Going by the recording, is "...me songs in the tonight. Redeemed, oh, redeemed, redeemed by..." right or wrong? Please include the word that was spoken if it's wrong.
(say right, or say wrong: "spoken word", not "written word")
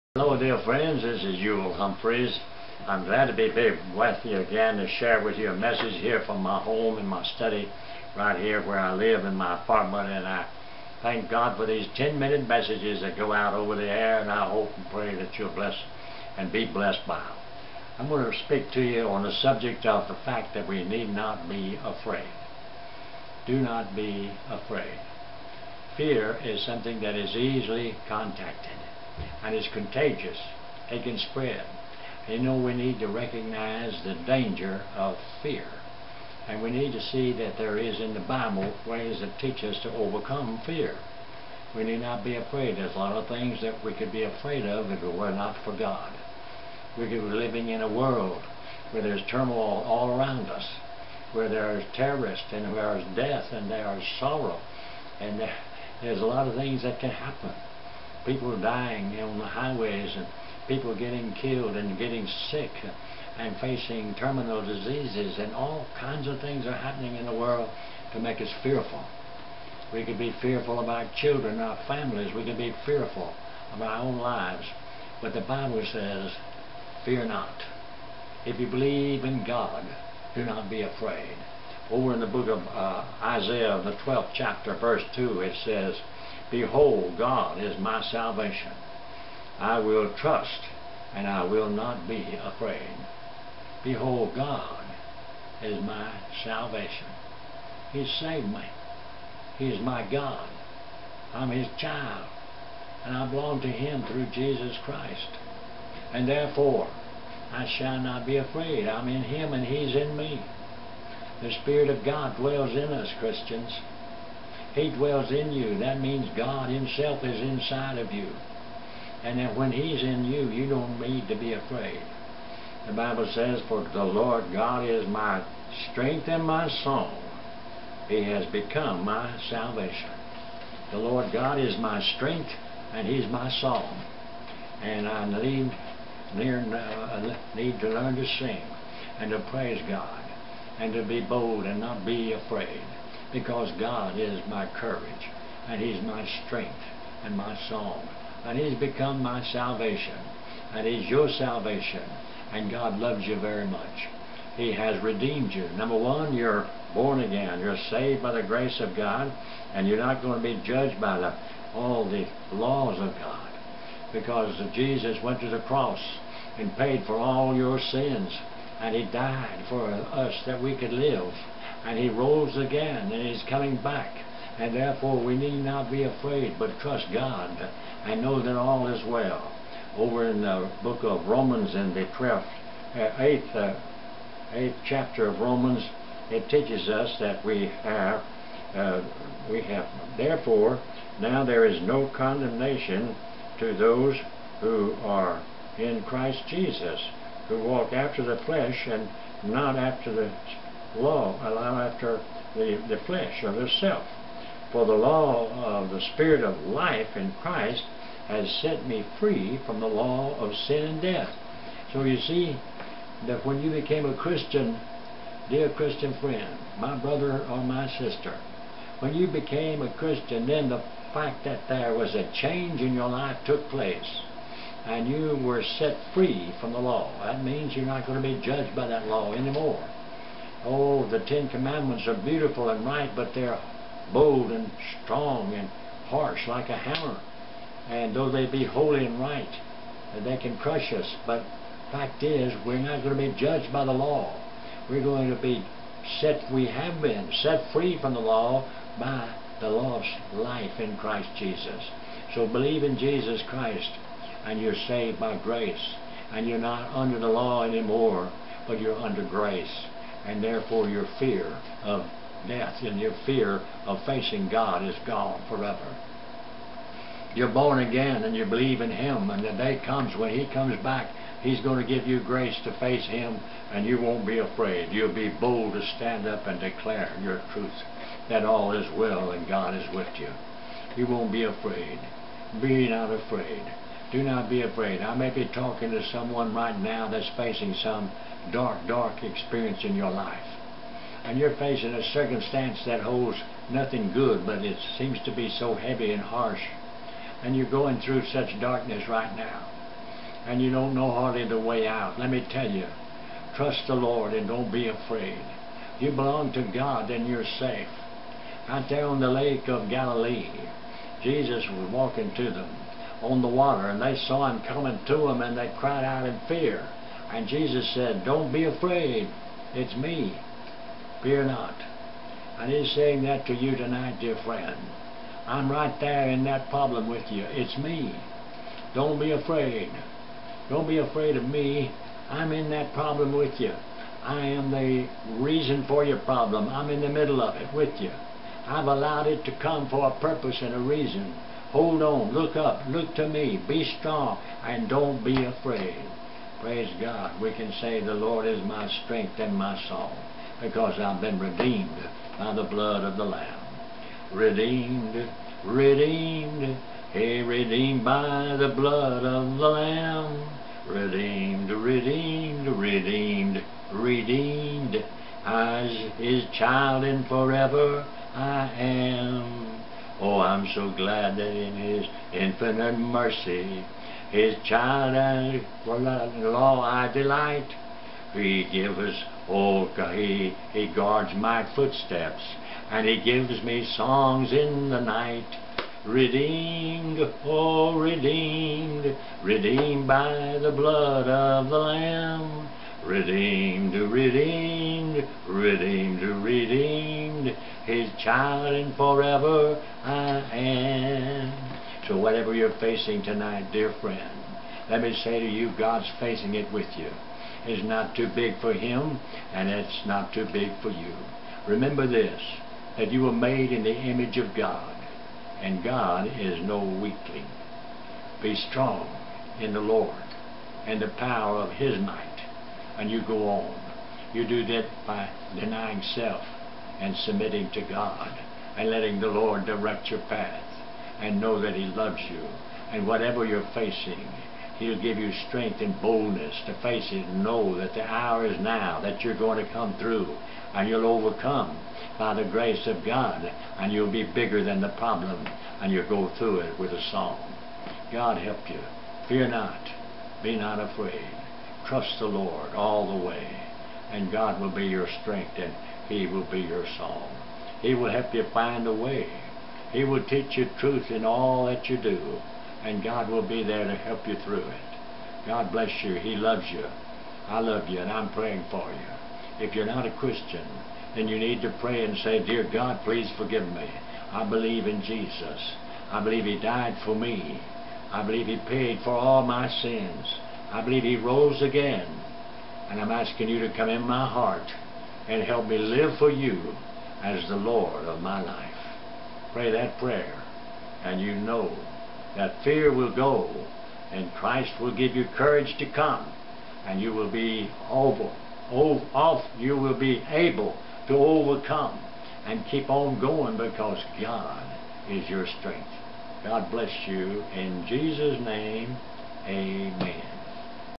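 wrong: "night", not "tonight".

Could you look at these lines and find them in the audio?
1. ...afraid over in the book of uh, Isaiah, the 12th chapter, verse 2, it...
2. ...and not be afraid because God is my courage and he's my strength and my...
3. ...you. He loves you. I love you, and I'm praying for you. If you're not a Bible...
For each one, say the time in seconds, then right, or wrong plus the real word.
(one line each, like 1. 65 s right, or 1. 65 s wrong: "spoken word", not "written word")
1. 80 s right
2. 141 s right
3. 466 s wrong: "Christian", not "Bible".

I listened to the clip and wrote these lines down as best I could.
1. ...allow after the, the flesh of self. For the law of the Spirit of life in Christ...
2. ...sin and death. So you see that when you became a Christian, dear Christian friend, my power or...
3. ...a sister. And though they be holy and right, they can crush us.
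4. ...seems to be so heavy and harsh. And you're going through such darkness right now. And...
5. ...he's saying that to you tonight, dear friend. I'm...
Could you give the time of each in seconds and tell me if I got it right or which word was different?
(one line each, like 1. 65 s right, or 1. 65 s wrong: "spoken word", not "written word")
1. 201 s right
2. 210 s wrong: "brother", not "power"
3. 236 s wrong: "hammer", not "sister"
4. 294 s right
5. 322 s right.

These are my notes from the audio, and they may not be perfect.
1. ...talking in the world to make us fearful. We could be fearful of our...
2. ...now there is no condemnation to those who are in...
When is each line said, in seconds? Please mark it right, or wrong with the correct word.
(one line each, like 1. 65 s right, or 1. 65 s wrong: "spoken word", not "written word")
1. 66 s wrong: "happening", not "talking"
2. 191 s right.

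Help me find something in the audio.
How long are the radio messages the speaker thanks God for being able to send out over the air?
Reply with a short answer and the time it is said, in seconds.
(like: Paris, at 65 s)
10 minutes, at 11 s.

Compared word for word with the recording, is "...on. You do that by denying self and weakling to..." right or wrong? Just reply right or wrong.
wrong.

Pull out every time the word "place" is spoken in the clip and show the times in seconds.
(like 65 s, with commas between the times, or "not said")
223 s.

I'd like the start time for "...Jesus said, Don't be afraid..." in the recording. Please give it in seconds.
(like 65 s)
317 s.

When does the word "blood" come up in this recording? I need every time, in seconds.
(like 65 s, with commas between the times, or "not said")
352 s, 358 s, 390 s.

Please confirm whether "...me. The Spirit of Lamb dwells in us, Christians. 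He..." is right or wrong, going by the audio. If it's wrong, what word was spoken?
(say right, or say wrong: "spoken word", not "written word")
wrong: "God", not "Lamb".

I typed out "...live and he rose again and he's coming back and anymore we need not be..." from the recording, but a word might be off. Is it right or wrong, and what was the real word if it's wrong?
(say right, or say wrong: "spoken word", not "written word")
wrong: "therefore", not "anymore".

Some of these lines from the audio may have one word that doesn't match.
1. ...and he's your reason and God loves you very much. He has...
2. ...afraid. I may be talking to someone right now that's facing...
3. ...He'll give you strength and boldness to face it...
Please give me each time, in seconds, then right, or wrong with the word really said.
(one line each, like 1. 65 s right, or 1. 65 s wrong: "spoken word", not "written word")
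1. 150 s wrong: "salvation", not "reason"
2. 284 s right
3. 434 s right.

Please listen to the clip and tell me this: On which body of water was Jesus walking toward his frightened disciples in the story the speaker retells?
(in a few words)
Lake of Galilee.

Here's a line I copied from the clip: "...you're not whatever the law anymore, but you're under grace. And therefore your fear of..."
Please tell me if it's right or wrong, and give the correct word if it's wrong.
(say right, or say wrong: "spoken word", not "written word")
wrong: "under", not "whatever".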